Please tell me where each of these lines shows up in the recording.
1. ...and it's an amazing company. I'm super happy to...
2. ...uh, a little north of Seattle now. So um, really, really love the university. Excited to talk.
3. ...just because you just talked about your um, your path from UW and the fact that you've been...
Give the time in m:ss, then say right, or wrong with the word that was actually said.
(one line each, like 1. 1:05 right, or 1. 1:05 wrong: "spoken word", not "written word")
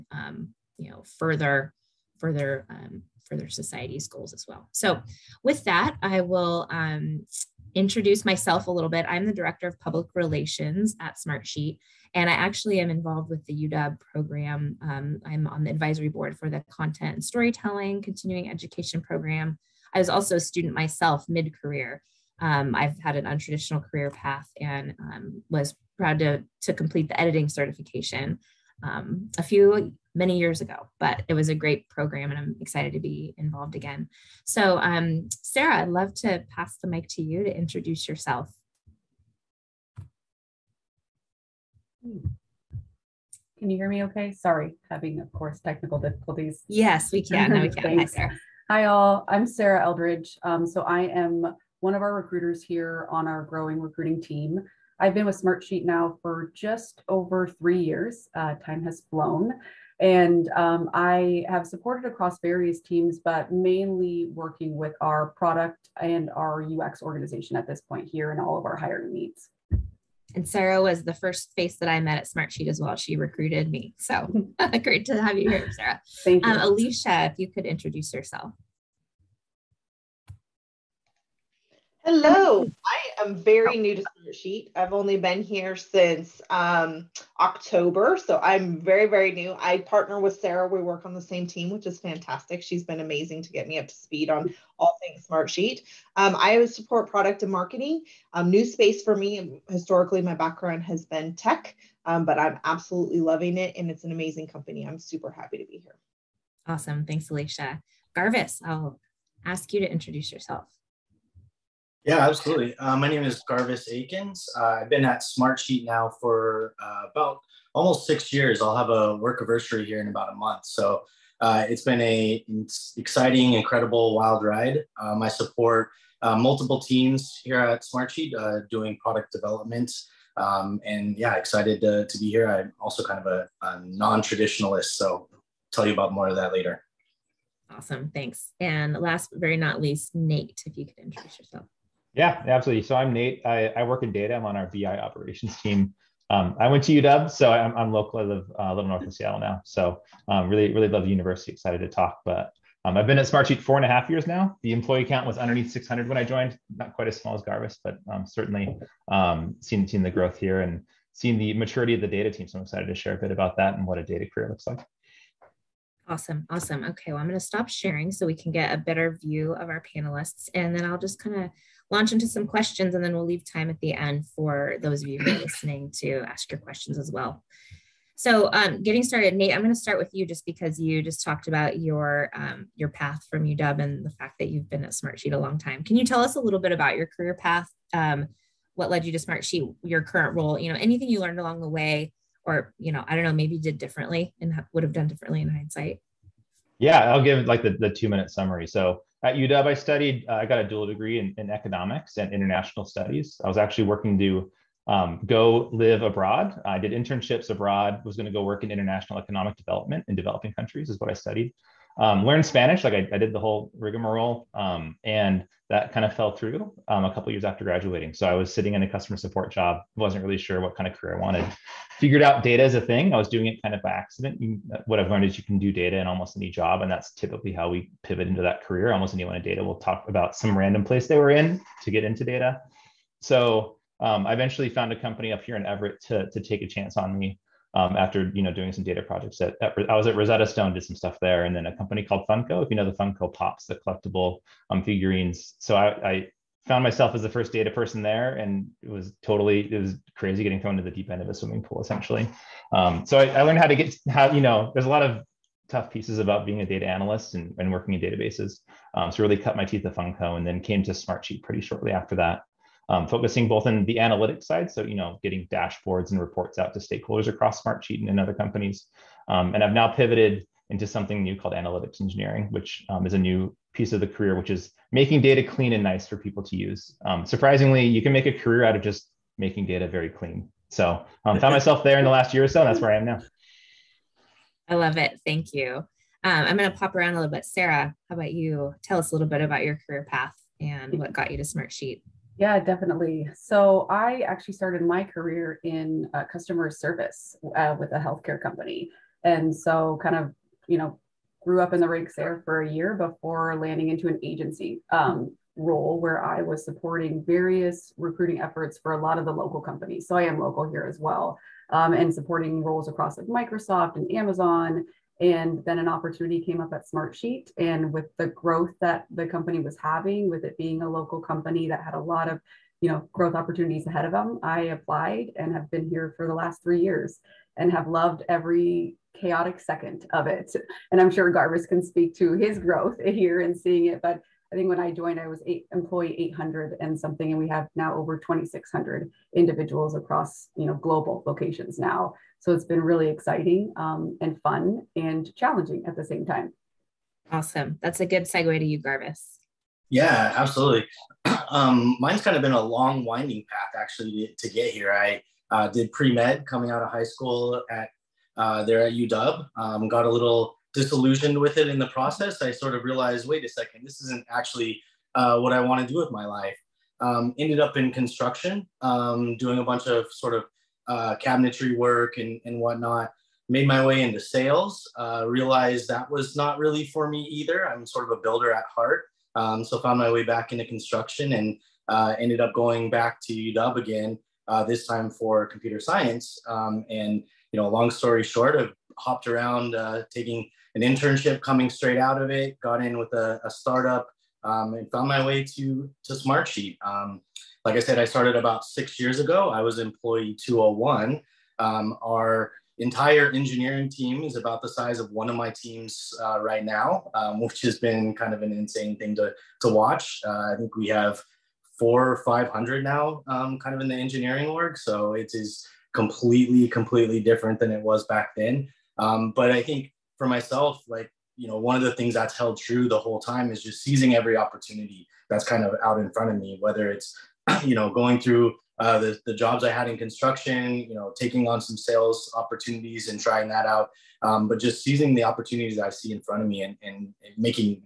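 1. 1:43 right
2. 2:28 right
3. 3:00 right.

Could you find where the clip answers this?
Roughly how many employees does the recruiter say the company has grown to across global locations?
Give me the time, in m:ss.
5:37.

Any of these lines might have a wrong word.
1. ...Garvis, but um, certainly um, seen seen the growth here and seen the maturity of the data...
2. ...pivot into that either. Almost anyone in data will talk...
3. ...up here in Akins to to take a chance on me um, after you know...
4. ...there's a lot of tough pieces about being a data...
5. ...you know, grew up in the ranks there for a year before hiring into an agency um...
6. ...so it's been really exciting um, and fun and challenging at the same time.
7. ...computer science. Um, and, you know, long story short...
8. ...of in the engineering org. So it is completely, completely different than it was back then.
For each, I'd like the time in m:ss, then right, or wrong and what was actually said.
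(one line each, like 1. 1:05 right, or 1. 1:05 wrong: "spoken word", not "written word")
1. 2:37 right
2. 3:48 wrong: "career", not "either"
3. 3:55 wrong: "Everett", not "Akins"
4. 4:14 right
5. 5:00 wrong: "landing", not "hiring"
6. 5:42 right
7. 6:25 right
8. 6:53 right.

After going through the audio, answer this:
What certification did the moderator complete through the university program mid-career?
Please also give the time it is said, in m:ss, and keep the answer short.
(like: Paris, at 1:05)
Editing certification, at 0:27.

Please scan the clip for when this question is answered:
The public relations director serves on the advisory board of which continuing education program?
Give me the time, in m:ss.
0:16.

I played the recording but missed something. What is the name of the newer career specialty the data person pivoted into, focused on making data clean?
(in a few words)
Analytics engineering.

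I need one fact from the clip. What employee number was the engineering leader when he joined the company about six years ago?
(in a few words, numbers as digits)
201.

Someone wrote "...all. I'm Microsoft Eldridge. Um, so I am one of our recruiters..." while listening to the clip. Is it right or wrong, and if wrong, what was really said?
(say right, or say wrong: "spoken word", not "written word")
wrong: "Sarah", not "Microsoft".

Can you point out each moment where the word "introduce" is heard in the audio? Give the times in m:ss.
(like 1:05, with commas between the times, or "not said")
0:07, 0:37, 1:17, 1:49, 2:20.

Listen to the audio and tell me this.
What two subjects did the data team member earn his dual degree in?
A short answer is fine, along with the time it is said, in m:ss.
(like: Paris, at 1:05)
Economics and international studies, at 3:21.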